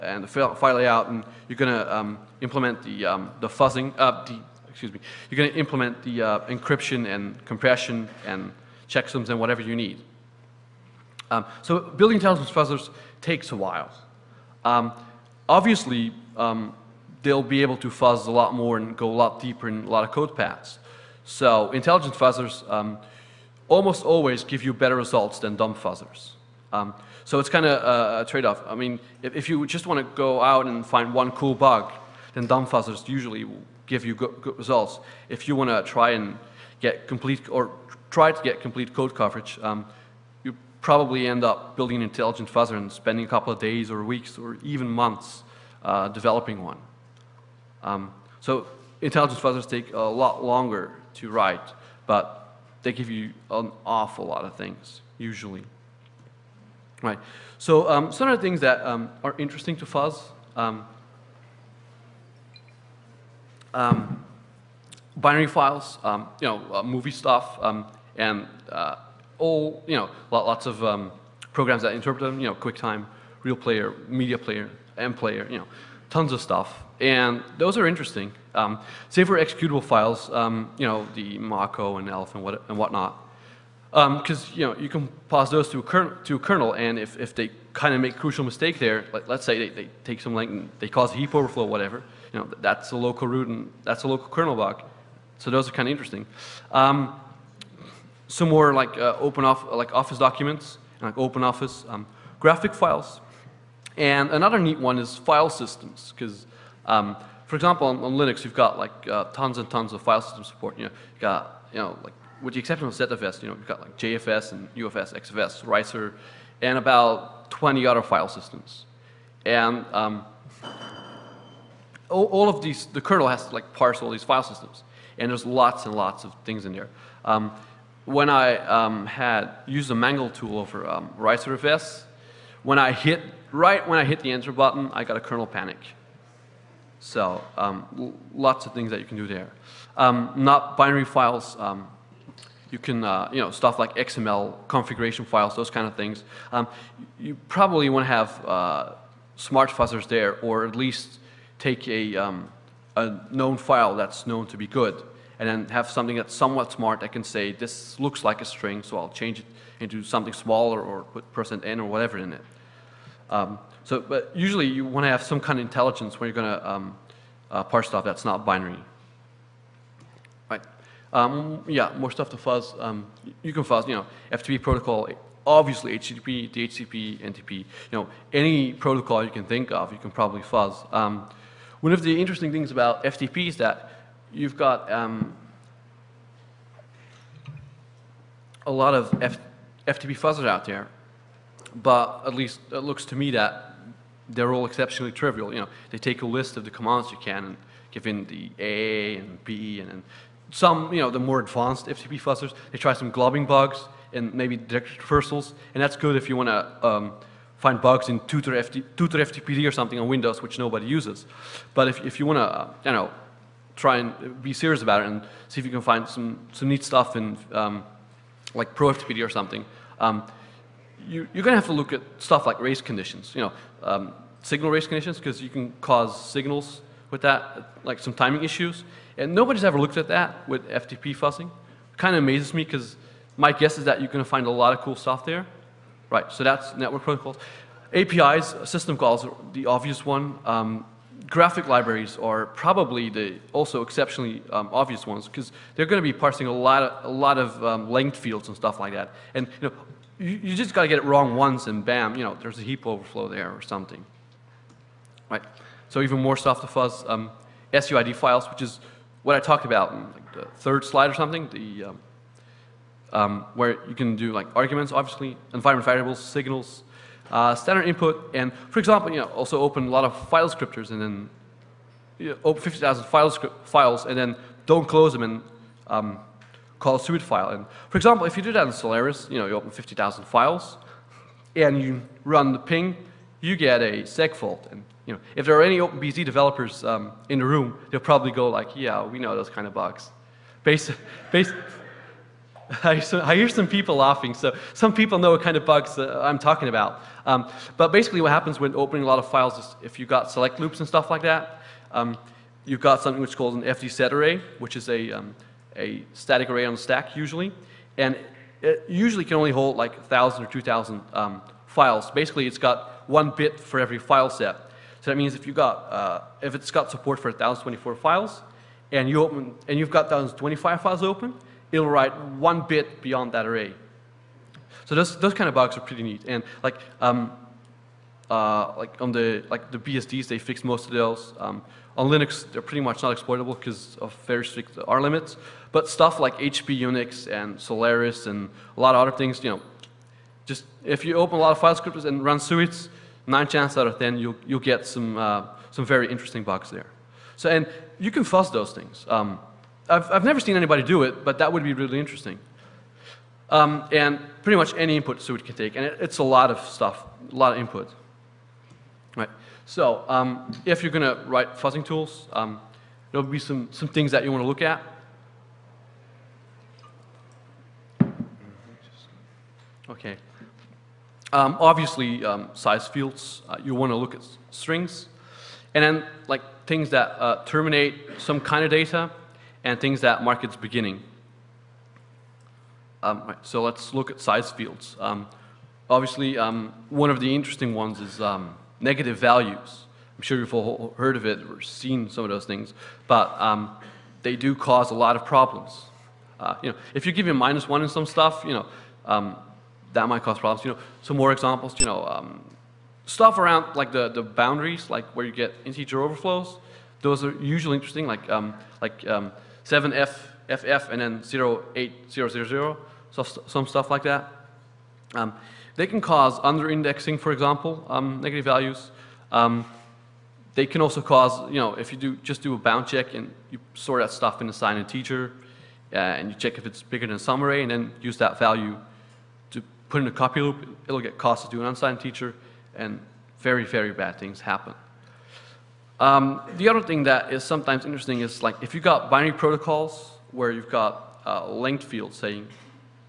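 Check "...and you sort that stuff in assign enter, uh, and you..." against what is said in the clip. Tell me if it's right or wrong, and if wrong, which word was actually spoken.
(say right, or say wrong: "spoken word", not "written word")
wrong: "integer", not "enter".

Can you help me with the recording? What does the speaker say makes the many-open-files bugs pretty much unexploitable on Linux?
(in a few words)
very strict R limits.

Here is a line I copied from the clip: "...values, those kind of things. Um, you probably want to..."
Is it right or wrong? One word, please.
wrong.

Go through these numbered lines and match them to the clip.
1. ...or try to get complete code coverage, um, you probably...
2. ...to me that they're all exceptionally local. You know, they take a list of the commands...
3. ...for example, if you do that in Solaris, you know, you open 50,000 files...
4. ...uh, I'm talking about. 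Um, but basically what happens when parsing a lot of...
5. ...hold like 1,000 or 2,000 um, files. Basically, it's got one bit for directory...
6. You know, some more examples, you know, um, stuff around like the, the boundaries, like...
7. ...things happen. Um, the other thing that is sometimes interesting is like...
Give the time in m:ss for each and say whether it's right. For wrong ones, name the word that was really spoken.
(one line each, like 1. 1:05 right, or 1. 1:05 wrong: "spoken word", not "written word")
1. 0:37 right
2. 3:13 wrong: "trivial", not "local"
3. 4:37 right
4. 4:55 wrong: "opening", not "parsing"
5. 5:09 wrong: "every", not "directory"
6. 6:40 right
7. 7:14 right.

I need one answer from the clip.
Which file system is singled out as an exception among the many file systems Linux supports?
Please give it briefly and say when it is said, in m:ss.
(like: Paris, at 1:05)
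ZFS, at 1:52.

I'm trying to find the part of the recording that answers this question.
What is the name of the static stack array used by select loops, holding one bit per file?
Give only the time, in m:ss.
5:03.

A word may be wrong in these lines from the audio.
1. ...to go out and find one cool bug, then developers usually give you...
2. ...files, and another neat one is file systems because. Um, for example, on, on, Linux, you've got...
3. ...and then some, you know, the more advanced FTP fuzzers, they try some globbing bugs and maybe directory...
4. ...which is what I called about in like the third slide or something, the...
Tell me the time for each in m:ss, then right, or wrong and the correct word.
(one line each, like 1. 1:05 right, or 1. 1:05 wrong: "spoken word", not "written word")
1. 0:30 wrong: "fuzzers", not "developers"
2. 1:42 right
3. 3:19 right
4. 4:18 wrong: "talked", not "called".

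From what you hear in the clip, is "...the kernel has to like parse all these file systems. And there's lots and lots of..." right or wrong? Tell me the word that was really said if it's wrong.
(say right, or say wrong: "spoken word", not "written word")
right.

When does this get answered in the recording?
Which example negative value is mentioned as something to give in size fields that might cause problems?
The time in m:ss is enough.
6:37.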